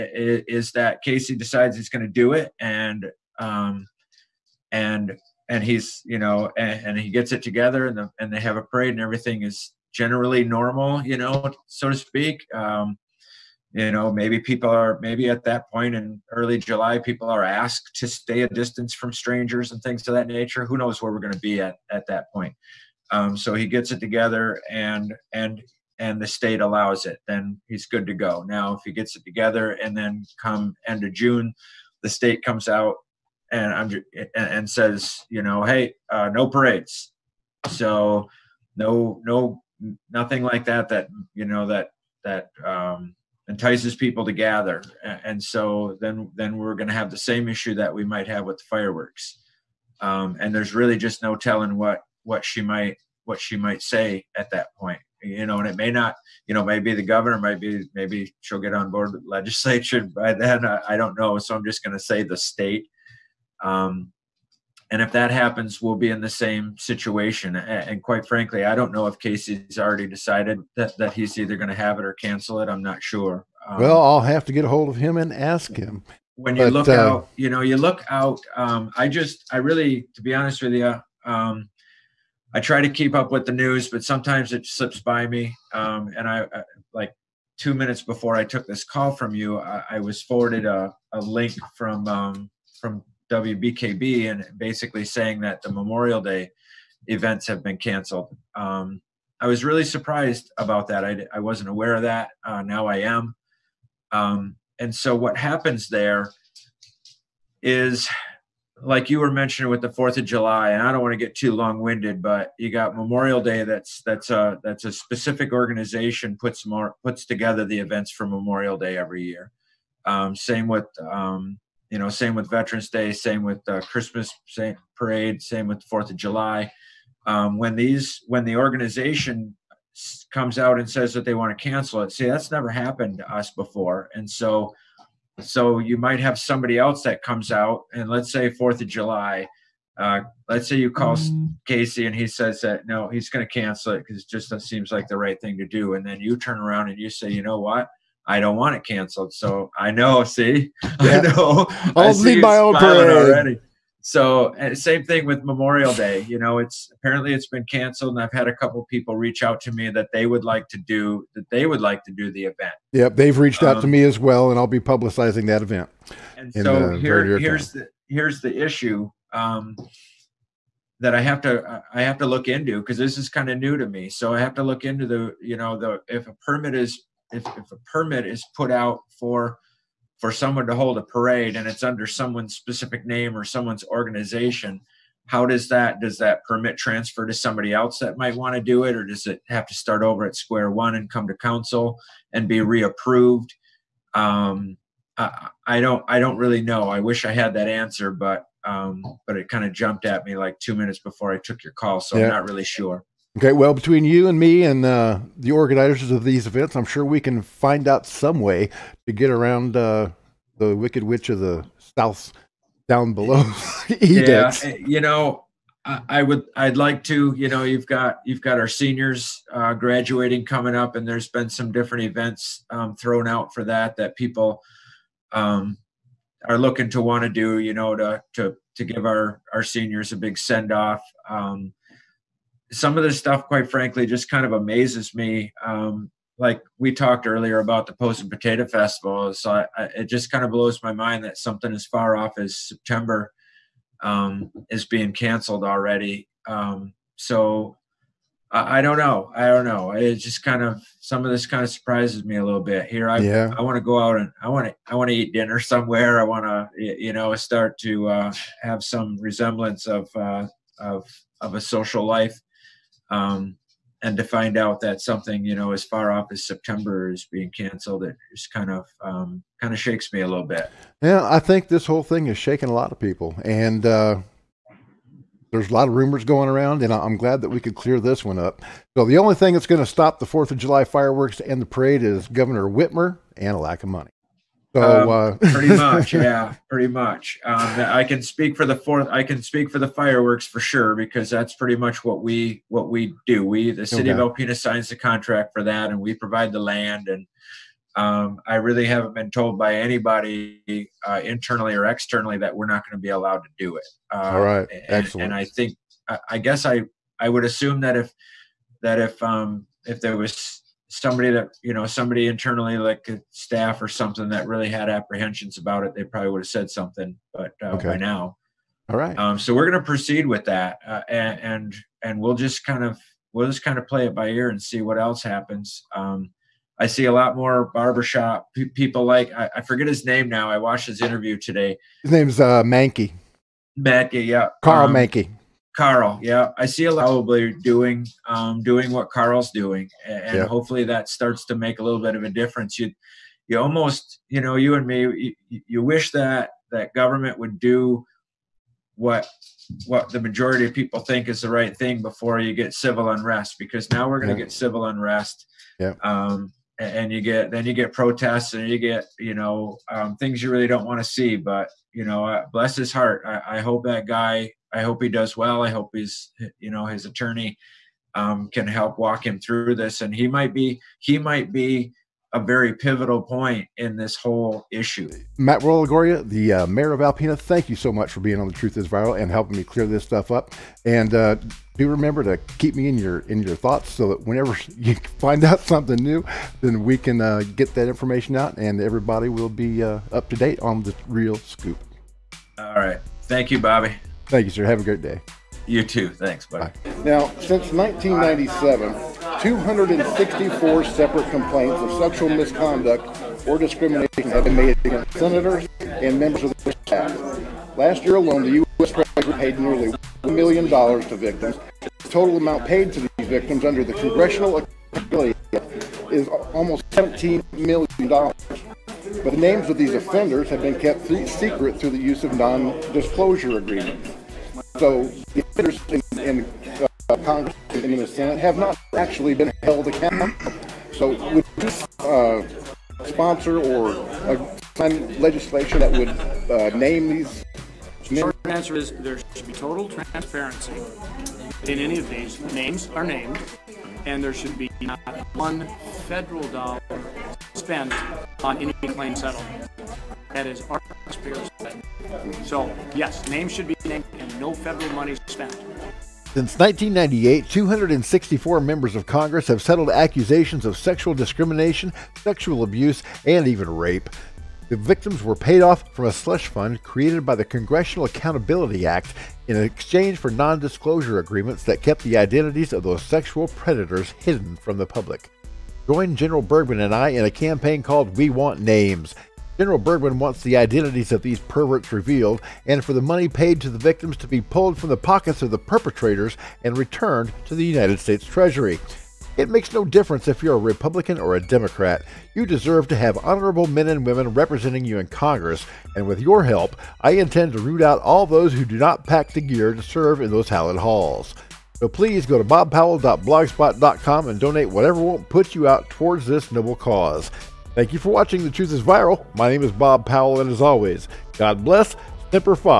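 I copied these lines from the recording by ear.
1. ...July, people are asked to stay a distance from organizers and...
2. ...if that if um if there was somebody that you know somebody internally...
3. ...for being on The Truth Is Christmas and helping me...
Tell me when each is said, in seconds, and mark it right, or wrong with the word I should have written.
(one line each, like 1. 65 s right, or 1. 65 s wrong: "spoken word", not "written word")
1. 16 s wrong: "strangers", not "organizers"
2. 307 s right
3. 378 s wrong: "Viral", not "Christmas".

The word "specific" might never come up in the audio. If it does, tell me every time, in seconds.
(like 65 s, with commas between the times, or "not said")
114 s, 182 s.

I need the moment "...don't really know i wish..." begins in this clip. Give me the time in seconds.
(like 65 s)
196 s.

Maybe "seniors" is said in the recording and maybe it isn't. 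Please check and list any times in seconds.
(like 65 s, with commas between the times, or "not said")
218 s, 229 s.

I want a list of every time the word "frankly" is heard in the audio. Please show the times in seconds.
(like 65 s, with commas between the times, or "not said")
68 s, 233 s.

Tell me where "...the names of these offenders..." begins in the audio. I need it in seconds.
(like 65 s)
419 s.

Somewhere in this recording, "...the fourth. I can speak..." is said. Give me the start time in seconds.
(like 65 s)
288 s.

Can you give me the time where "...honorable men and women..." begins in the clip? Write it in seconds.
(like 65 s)
493 s.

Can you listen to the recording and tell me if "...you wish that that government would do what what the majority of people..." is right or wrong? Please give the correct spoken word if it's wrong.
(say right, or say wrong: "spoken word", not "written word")
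right.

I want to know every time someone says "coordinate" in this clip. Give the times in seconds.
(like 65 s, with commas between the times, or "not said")
not said.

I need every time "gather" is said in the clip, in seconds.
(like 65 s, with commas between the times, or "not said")
44 s.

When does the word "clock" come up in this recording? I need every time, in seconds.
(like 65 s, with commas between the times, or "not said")
not said.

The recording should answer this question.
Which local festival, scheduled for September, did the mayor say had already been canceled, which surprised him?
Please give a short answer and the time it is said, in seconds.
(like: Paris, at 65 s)
Posen Potato Festival, at 237 s.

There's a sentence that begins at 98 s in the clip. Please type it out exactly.
Um, I was really surprised about that.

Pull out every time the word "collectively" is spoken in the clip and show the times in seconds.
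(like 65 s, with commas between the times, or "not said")
not said.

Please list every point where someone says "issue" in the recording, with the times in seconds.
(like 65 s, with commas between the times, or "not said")
47 s, 168 s, 374 s.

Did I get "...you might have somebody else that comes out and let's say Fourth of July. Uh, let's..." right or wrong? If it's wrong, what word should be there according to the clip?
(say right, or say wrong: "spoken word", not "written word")
right.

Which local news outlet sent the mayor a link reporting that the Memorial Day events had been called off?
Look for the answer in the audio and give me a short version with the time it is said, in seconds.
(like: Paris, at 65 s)
WBKB, at 93 s.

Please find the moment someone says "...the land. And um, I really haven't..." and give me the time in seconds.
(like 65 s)
296 s.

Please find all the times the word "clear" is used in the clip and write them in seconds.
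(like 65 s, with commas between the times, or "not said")
277 s, 379 s.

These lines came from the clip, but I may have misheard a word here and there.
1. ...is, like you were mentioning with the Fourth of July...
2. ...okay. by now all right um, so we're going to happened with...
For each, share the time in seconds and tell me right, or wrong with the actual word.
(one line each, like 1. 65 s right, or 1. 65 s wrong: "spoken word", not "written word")
1. 107 s right
2. 317 s wrong: "proceed", not "happened".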